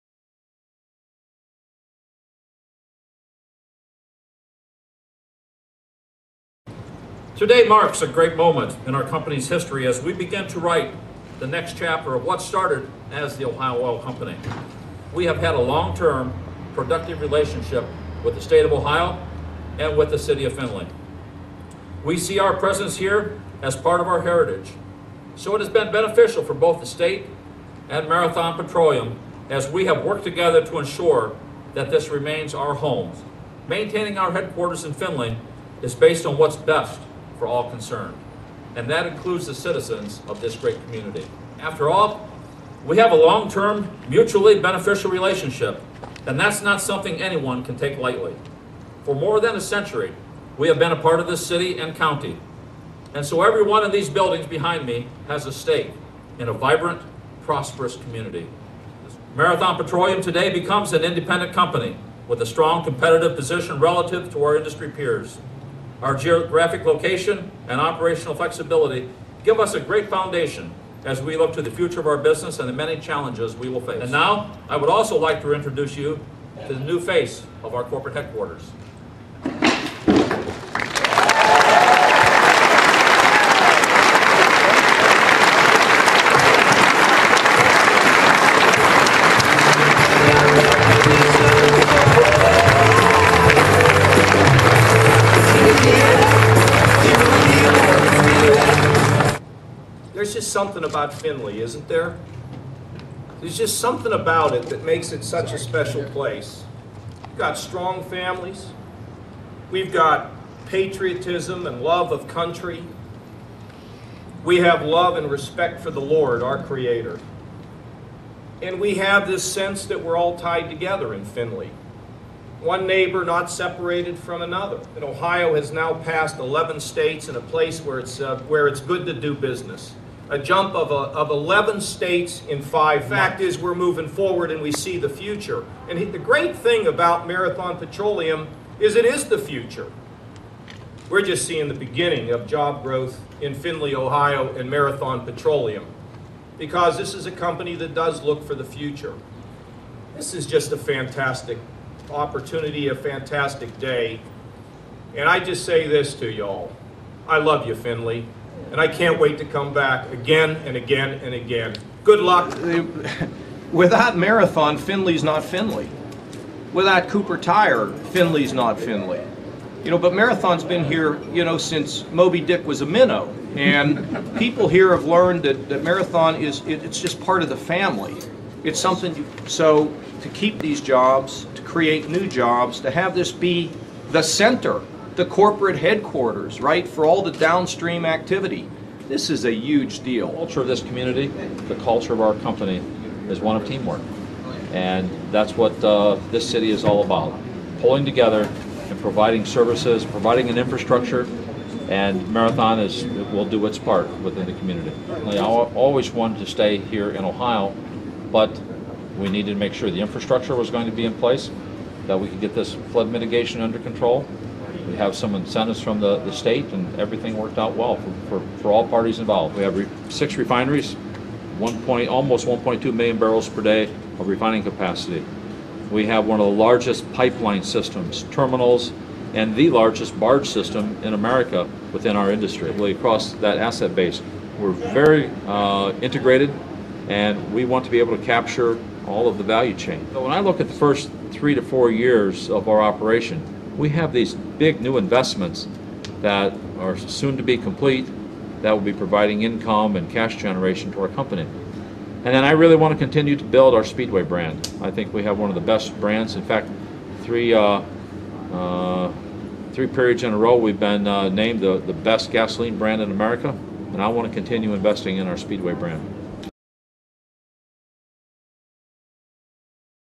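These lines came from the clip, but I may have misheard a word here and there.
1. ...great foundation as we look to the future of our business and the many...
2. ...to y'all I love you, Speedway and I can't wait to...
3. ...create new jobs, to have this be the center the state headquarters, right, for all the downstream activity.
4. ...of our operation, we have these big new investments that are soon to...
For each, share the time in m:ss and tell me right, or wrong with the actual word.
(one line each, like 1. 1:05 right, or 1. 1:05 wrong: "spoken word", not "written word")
1. 1:09 right
2. 2:36 wrong: "Findlay", not "Speedway"
3. 3:01 wrong: "corporate", not "state"
4. 4:02 right.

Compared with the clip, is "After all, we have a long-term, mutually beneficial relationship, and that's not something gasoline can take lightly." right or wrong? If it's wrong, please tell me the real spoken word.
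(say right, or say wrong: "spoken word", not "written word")
wrong: "anyone", not "gasoline".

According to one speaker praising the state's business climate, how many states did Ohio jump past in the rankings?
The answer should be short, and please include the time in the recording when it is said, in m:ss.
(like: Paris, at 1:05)
11, at 2:11.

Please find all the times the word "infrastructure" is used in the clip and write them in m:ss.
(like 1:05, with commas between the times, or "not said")
3:20, 3:30.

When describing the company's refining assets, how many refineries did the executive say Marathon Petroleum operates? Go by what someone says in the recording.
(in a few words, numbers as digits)
6.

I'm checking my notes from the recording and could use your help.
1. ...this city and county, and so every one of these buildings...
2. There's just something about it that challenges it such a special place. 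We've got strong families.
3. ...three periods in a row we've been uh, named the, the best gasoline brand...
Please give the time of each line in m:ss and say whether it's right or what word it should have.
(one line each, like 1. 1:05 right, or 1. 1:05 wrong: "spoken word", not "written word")
1. 0:51 right
2. 1:43 wrong: "makes", not "challenges"
3. 4:19 right.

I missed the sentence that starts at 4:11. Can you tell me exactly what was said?
And then I really want to continue to build our Speedway brand.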